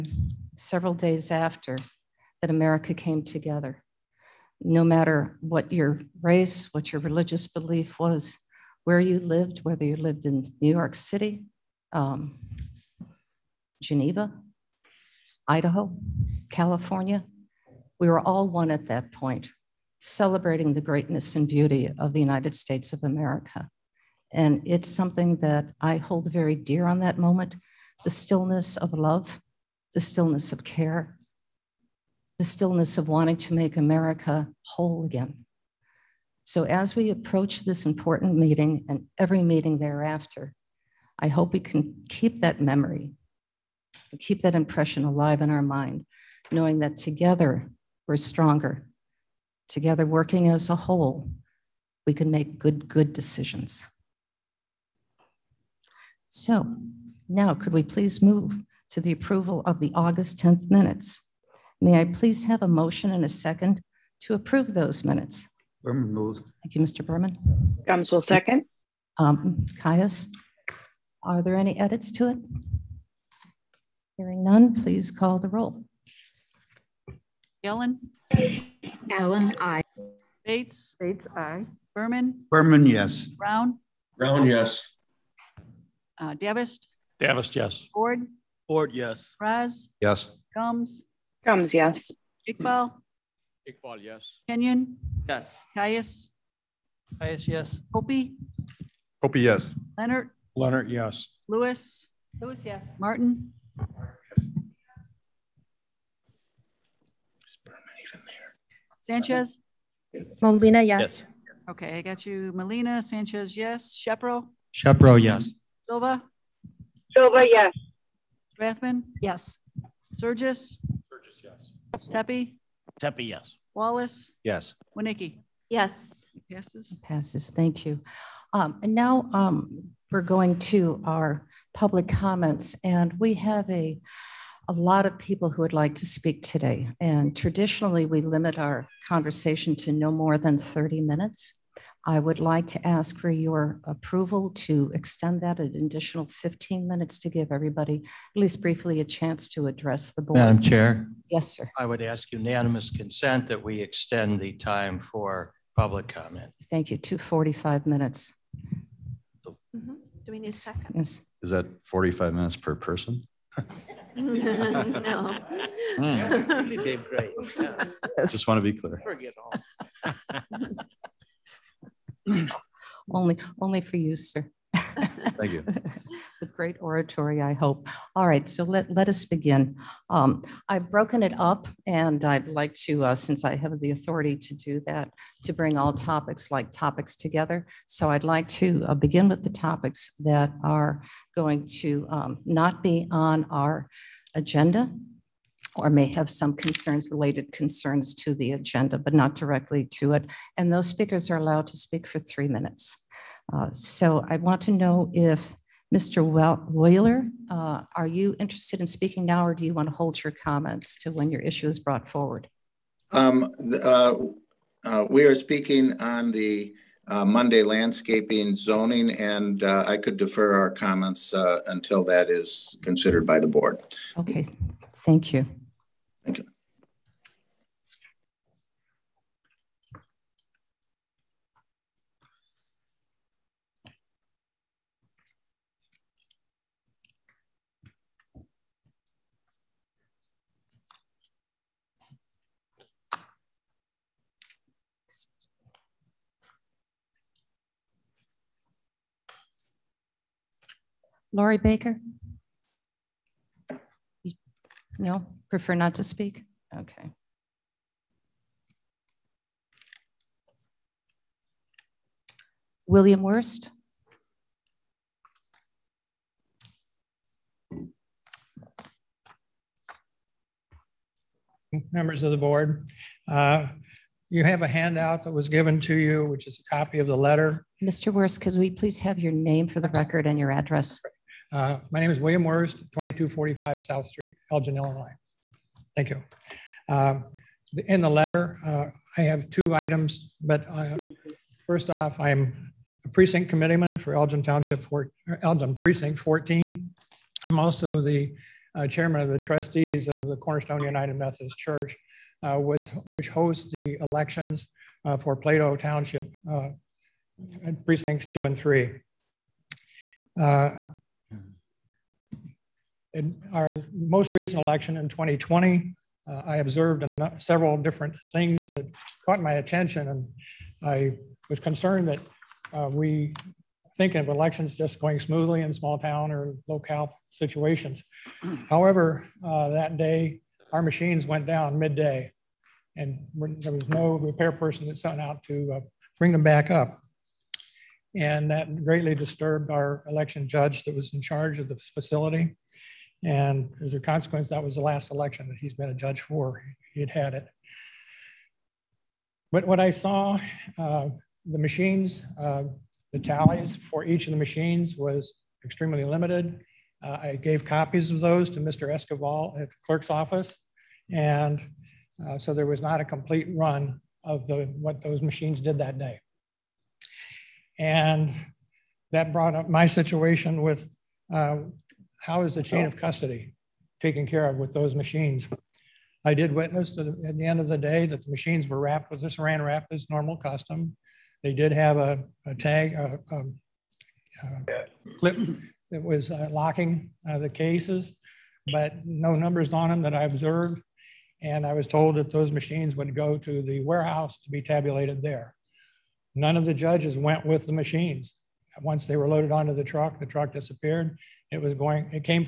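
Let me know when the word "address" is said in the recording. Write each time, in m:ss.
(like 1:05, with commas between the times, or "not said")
2:29, 4:40.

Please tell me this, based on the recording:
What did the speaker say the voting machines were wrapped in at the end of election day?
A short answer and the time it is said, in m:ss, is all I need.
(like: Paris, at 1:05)
ran wrap, at 6:19.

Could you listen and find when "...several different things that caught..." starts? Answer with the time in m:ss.
5:17.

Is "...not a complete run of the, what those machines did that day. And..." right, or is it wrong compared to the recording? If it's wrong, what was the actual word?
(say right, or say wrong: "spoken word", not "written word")
right.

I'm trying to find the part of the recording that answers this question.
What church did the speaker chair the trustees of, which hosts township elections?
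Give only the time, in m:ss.
5:00.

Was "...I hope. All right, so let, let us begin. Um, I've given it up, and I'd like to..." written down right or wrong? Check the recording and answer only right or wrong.
wrong.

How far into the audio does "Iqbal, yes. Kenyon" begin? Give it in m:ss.
1:33.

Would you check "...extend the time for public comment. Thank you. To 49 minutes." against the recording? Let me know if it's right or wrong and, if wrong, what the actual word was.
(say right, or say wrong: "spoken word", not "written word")
wrong: "45", not "49".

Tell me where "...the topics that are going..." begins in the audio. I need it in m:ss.
3:09.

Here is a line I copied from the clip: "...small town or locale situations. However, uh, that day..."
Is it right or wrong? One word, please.
right.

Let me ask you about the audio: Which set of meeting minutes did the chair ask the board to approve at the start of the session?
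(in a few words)
August 10th.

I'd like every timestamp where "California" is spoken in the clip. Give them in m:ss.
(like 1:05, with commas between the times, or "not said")
0:16.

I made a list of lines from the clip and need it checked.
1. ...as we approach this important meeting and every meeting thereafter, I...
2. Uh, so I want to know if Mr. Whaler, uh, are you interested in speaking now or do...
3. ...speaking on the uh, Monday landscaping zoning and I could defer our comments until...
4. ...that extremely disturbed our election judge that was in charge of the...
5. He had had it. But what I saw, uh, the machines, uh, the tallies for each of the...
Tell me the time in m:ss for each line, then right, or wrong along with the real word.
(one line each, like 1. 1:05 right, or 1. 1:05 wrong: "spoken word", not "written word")
1. 0:36 right
2. 3:23 right
3. 3:35 right
4. 5:38 wrong: "greatly", not "extremely"
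5. 5:46 right.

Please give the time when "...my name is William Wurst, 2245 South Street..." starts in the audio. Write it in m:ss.
4:41.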